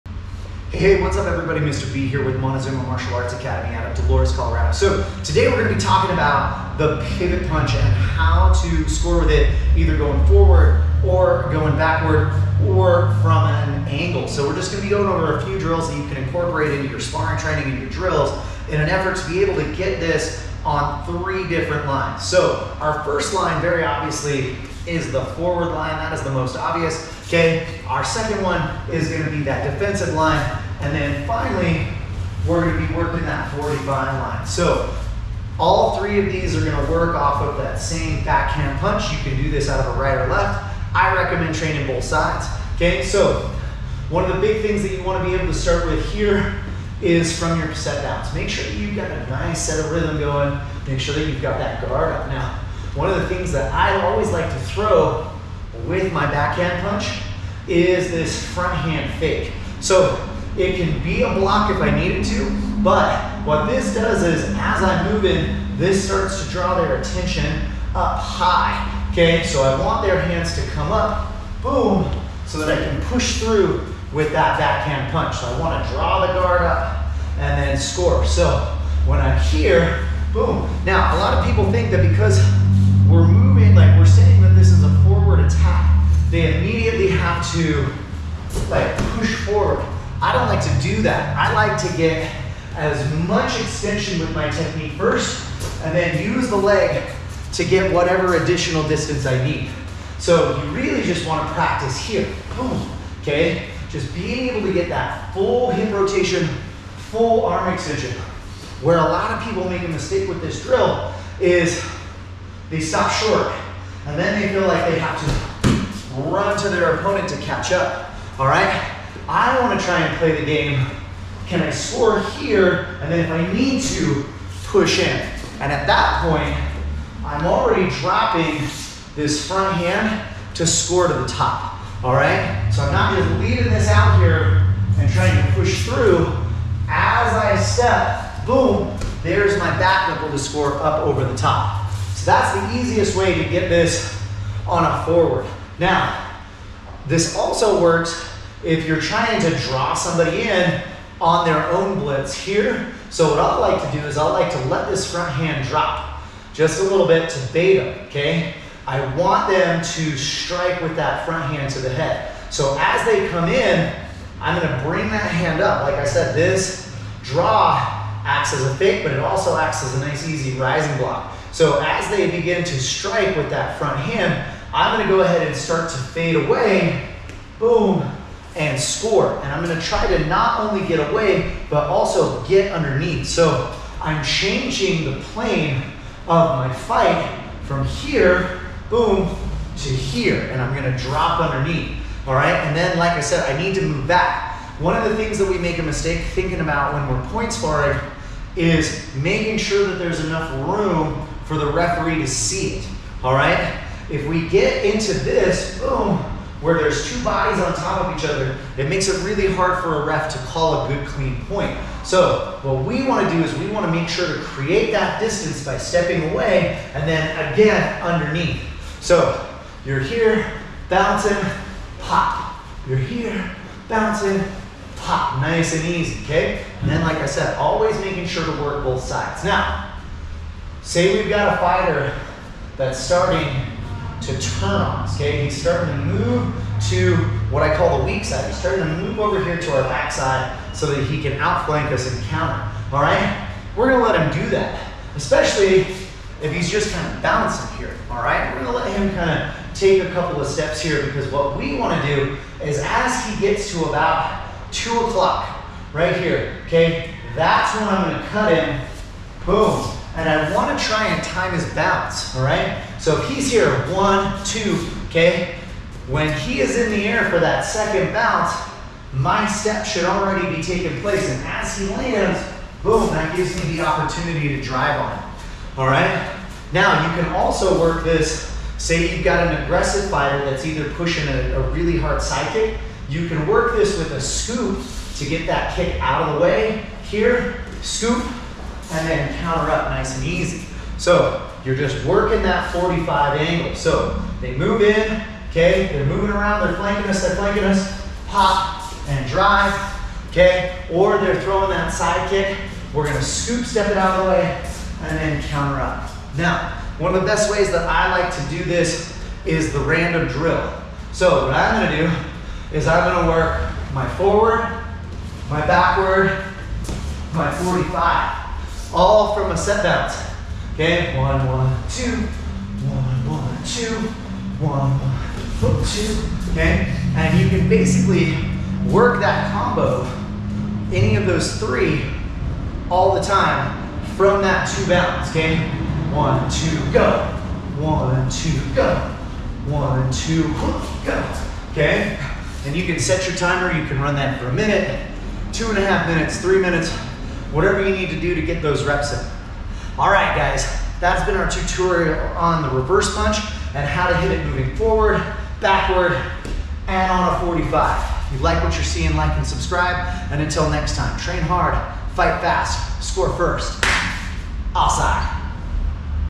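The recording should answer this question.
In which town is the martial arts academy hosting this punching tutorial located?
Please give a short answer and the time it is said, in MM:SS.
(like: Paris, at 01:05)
Dolores, Colorado, at 00:04.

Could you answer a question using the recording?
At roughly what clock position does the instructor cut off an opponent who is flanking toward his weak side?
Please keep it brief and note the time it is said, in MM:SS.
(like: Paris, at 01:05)
2 o'clock, at 04:14.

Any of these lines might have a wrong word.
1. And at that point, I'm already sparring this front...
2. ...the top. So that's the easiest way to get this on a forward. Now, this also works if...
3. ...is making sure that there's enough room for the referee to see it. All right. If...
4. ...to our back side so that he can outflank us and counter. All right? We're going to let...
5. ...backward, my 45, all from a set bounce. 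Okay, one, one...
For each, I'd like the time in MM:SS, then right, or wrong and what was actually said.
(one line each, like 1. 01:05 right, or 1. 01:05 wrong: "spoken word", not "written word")
1. 02:05 wrong: "dropping", not "sparring"
2. 02:21 right
3. 03:18 right
4. 03:59 right
5. 05:15 right.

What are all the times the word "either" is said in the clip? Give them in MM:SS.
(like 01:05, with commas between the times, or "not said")
00:09, 04:40.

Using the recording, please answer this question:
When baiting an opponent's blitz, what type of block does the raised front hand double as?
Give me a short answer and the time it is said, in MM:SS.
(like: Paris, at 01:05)
rising block, at 02:50.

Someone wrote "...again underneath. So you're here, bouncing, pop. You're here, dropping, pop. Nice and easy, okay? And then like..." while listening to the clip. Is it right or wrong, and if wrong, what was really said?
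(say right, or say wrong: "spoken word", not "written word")
wrong: "bouncing", not "dropping".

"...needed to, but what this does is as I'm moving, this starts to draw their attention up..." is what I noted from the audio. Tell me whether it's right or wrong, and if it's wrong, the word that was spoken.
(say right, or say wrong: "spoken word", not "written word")
right.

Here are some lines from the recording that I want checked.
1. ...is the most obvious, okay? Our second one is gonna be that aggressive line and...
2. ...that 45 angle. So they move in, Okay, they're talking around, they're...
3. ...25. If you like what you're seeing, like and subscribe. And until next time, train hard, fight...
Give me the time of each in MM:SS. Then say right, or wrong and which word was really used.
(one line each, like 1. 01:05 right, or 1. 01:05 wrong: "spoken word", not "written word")
1. 00:26 wrong: "defensive", not "aggressive"
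2. 04:52 wrong: "moving", not "talking"
3. 05:57 wrong: "45", not "25".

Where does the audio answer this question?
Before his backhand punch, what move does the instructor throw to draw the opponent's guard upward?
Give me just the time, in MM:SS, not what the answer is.
00:58.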